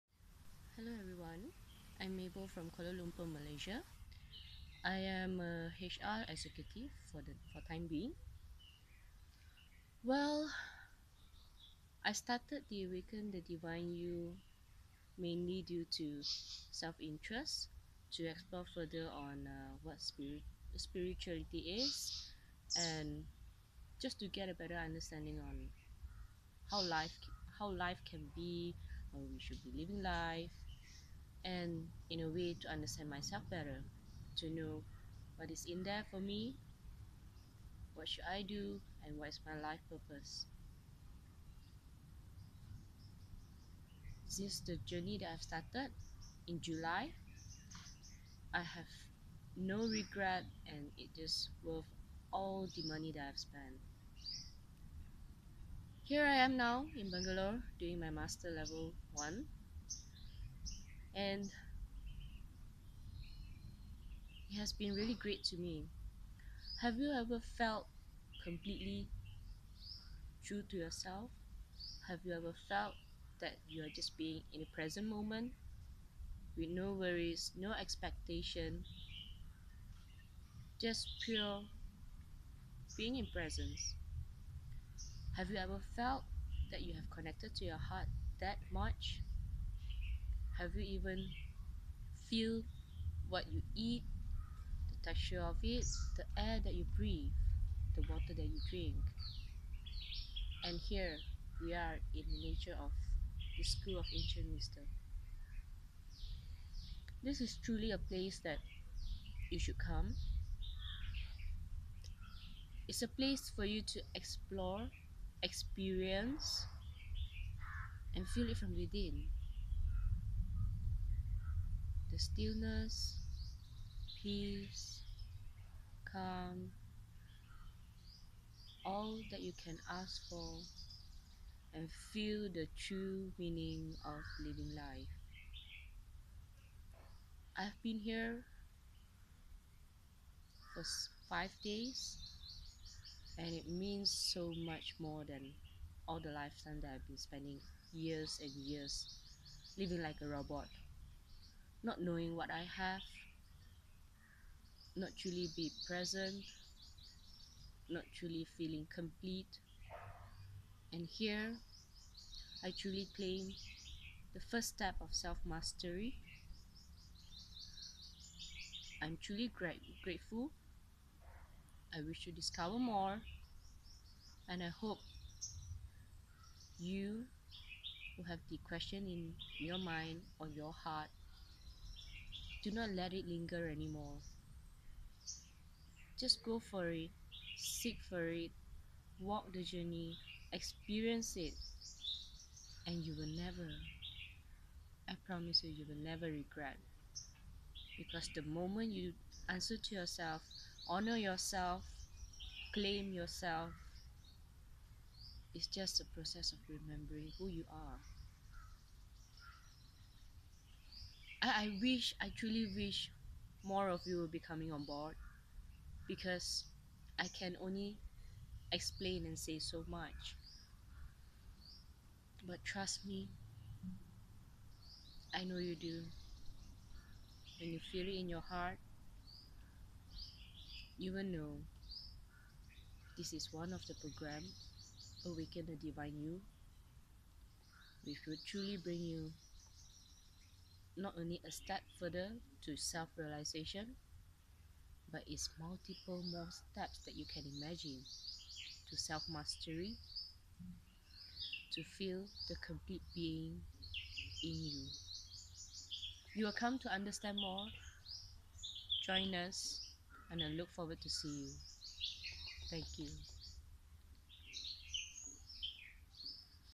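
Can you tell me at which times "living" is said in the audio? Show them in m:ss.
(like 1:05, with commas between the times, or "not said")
0:29, 2:14, 2:29.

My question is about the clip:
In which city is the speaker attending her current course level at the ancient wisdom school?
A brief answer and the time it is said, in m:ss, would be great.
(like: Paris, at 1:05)
Bangalore, at 0:57.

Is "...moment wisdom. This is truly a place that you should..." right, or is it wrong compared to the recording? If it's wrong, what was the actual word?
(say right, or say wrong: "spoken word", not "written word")
wrong: "ancient", not "moment".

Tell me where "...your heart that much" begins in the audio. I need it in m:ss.
1:27.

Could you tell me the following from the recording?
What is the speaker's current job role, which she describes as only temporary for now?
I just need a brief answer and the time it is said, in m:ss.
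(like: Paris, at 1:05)
HR executive, at 0:05.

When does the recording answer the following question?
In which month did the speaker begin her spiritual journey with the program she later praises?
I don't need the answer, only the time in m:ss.
0:46.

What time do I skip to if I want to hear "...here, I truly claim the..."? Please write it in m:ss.
2:41.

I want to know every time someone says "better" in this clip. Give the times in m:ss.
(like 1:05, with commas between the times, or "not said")
0:24, 0:33.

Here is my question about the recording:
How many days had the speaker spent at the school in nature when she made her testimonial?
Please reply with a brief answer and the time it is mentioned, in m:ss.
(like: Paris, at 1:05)
5, at 2:21.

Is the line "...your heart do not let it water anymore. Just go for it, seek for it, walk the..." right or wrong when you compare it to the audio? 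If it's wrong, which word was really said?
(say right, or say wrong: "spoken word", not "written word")
wrong: "linger", not "water".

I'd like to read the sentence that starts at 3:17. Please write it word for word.
Because the moment you answer to yourself, honor yourself, claim yourself, it's just a process of remembering who you are.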